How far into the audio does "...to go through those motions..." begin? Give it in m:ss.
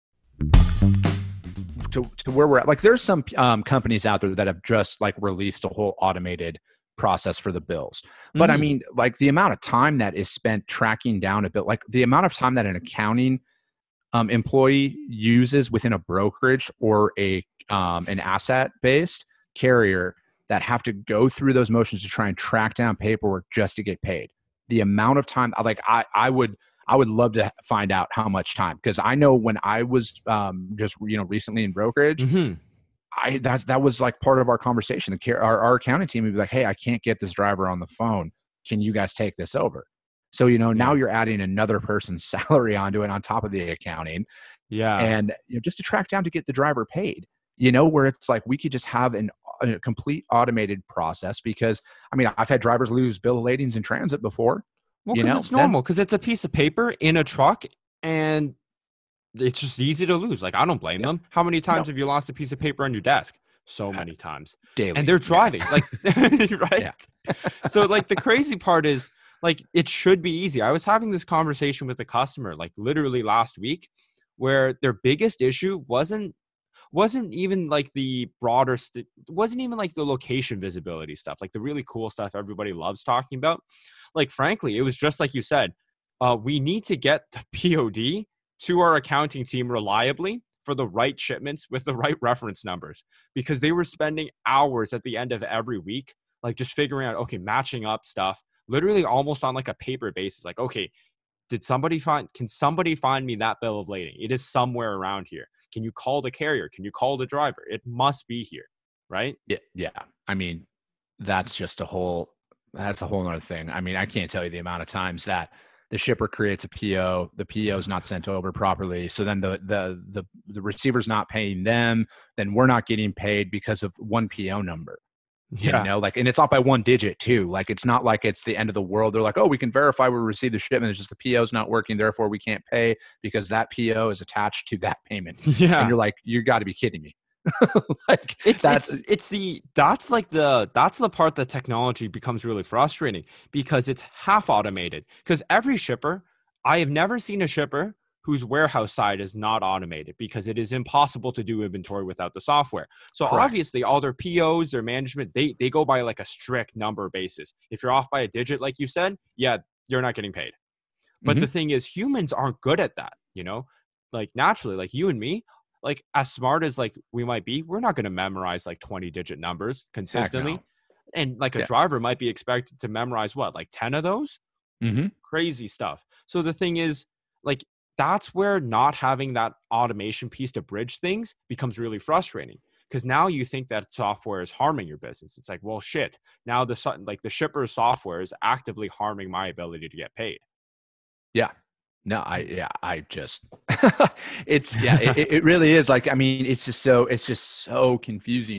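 0:20.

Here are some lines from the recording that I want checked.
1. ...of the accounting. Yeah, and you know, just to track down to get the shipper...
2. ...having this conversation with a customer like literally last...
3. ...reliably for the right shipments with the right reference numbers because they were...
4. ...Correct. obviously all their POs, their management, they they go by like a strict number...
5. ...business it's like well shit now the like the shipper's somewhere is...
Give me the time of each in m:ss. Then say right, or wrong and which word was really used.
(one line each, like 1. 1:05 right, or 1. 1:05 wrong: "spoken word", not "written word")
1. 0:43 wrong: "driver", not "shipper"
2. 1:10 right
3. 1:29 right
4. 2:33 right
5. 3:04 wrong: "software", not "somewhere".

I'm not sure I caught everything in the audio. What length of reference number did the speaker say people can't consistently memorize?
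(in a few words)
20 digits.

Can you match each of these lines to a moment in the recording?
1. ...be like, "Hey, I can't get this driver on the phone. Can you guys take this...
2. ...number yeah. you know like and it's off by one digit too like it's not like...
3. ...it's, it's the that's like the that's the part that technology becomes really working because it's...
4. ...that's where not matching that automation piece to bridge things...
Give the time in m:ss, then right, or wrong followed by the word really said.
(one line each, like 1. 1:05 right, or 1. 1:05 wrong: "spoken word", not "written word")
1. 0:36 right
2. 2:04 right
3. 2:18 wrong: "frustrating", not "working"
4. 2:58 wrong: "having", not "matching".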